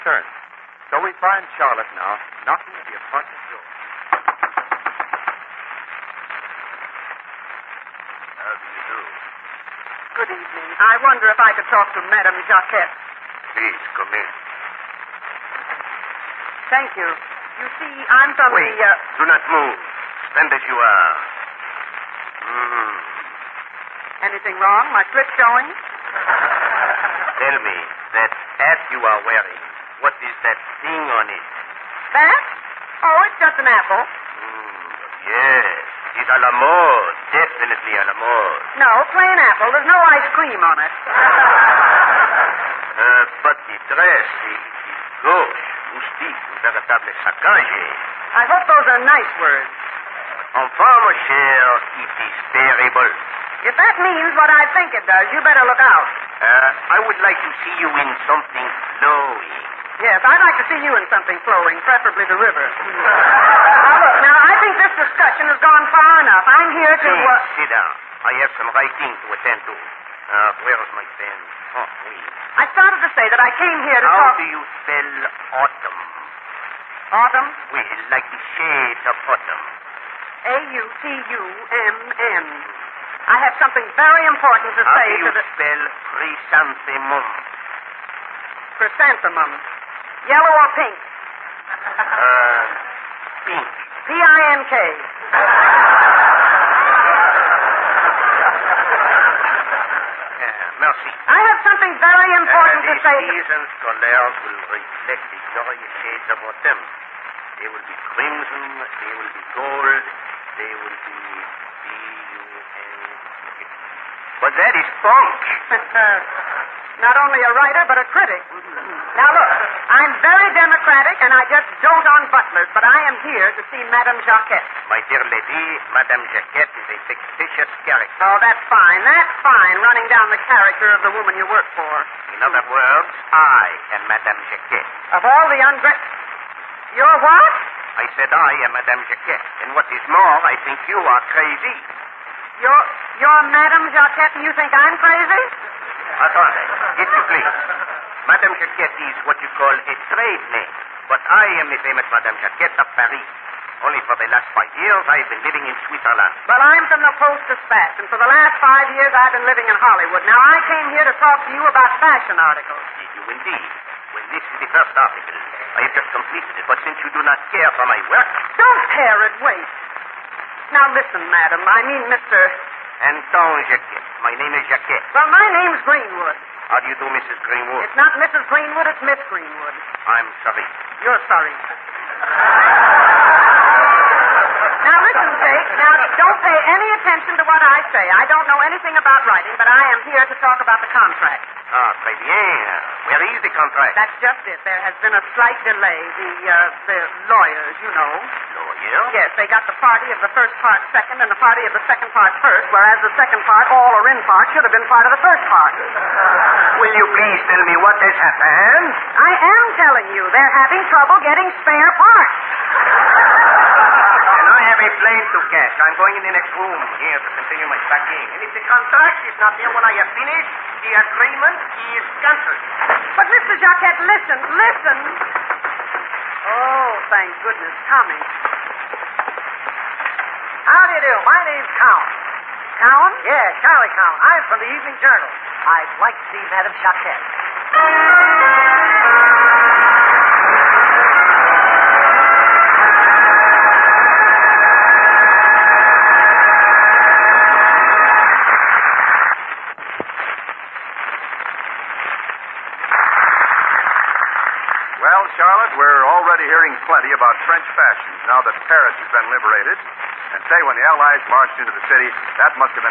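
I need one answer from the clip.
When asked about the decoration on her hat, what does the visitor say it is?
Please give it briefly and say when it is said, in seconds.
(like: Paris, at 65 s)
An apple, at 33 s.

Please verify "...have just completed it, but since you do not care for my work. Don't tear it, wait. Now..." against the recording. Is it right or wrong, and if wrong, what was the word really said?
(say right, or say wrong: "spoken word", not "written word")
right.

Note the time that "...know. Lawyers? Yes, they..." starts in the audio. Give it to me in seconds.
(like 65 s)
197 s.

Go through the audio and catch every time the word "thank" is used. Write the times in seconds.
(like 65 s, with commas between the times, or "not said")
16 s, 227 s.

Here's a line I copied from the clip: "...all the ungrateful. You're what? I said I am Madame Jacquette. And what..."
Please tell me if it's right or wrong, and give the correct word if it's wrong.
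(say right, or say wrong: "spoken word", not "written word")
right.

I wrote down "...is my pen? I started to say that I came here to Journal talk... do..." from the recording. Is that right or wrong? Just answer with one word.
wrong.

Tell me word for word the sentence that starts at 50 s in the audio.
Enfin, mon cher, it is terrible.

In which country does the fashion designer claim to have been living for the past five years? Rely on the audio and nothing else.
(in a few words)
Switzerland.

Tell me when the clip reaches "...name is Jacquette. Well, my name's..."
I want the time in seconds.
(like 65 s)
174 s.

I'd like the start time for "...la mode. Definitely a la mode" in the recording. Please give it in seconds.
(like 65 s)
36 s.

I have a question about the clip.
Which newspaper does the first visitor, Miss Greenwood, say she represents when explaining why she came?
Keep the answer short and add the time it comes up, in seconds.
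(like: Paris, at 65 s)
Post Dispatch, at 157 s.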